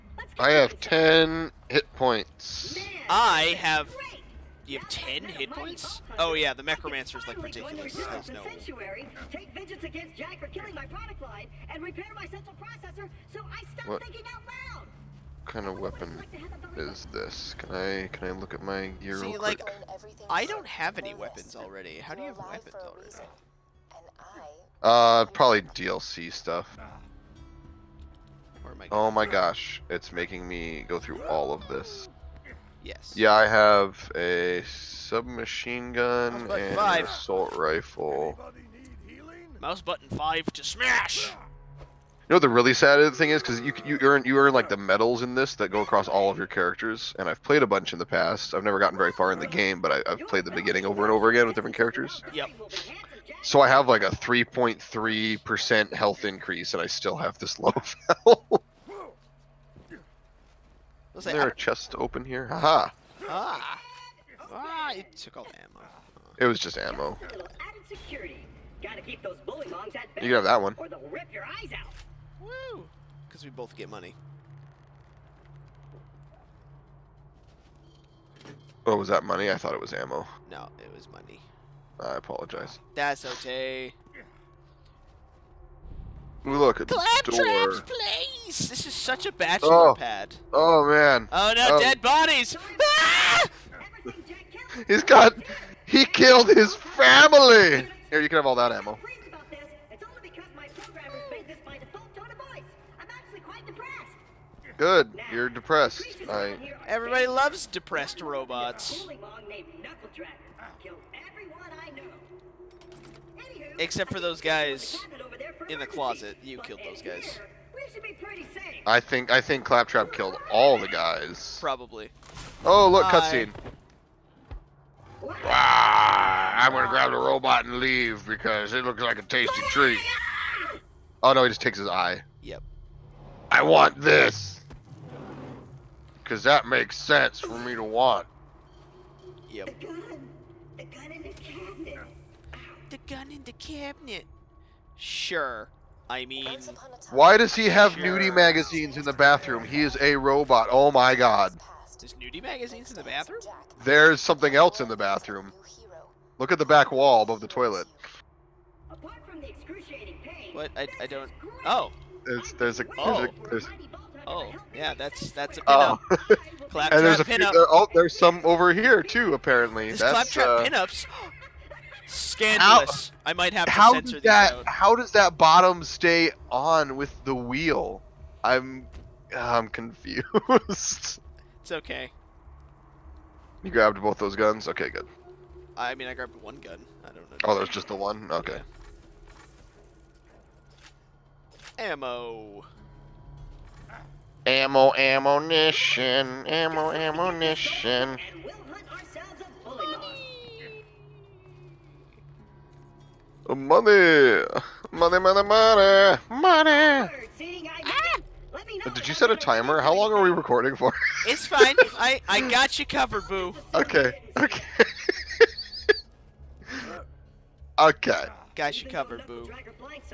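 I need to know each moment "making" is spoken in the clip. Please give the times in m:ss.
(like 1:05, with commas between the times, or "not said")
0:30.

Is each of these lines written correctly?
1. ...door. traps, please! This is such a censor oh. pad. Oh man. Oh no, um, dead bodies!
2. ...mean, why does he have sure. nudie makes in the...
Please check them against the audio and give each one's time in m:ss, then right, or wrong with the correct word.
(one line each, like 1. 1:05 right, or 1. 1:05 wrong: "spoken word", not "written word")
1. 1:27 wrong: "bachelor", not "censor"
2. 2:26 wrong: "magazines", not "makes".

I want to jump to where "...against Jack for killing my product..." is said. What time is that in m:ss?
0:09.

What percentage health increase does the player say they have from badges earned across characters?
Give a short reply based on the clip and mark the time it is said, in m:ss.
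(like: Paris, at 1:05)
3.3 percent, at 0:54.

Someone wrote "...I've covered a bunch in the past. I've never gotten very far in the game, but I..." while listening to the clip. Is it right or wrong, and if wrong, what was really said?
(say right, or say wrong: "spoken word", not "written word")
wrong: "played", not "covered".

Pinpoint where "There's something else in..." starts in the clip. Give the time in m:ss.
2:33.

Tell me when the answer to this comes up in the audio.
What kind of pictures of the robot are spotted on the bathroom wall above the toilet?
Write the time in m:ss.
2:50.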